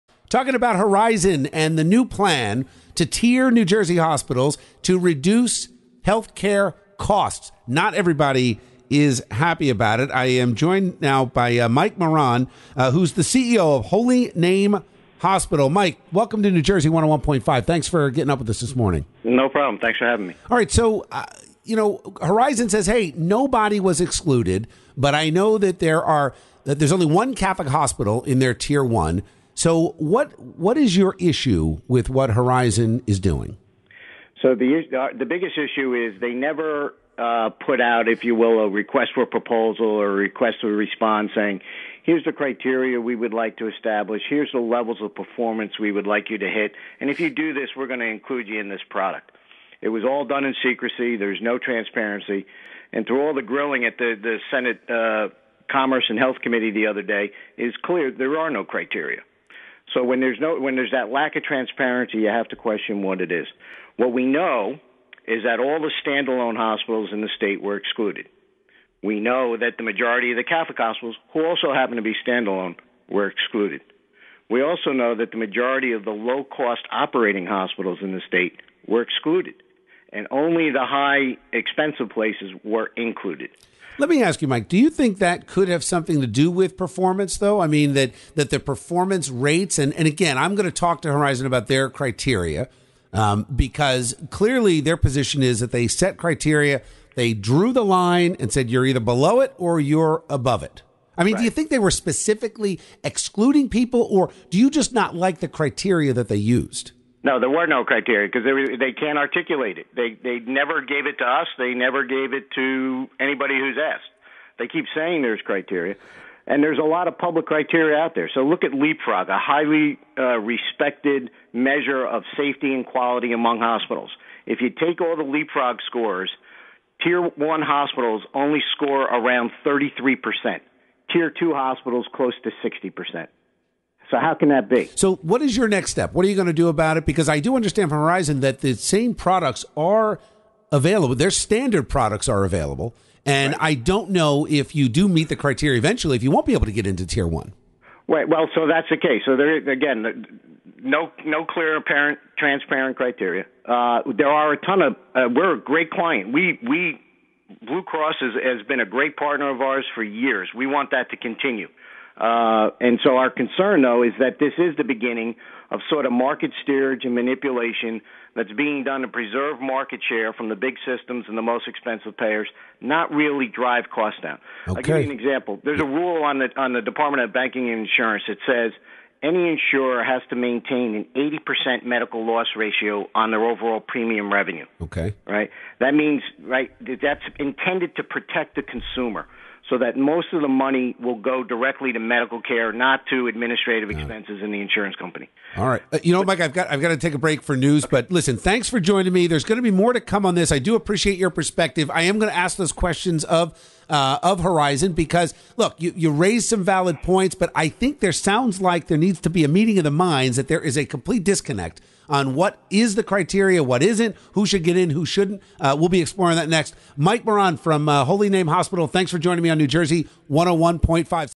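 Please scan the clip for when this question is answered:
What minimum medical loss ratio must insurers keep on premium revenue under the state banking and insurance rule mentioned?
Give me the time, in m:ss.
3:01.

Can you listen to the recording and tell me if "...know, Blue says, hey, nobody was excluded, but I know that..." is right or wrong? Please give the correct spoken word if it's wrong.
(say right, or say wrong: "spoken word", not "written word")
wrong: "Horizon", not "Blue".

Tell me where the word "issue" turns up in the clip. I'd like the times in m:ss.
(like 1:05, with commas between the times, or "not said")
0:31, 0:35.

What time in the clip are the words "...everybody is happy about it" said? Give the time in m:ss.
0:07.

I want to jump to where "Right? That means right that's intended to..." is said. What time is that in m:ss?
3:05.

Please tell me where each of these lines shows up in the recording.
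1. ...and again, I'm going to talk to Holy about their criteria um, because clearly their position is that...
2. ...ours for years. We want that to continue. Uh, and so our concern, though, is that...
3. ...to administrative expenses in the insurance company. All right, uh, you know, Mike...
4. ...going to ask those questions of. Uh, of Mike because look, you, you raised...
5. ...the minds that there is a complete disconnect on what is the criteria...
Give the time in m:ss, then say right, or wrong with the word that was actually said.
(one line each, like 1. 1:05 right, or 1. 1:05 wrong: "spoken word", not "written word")
1. 1:29 wrong: "Horizon", not "Holy"
2. 2:39 right
3. 3:13 right
4. 3:22 wrong: "Horizon", not "Mike"
5. 3:29 right.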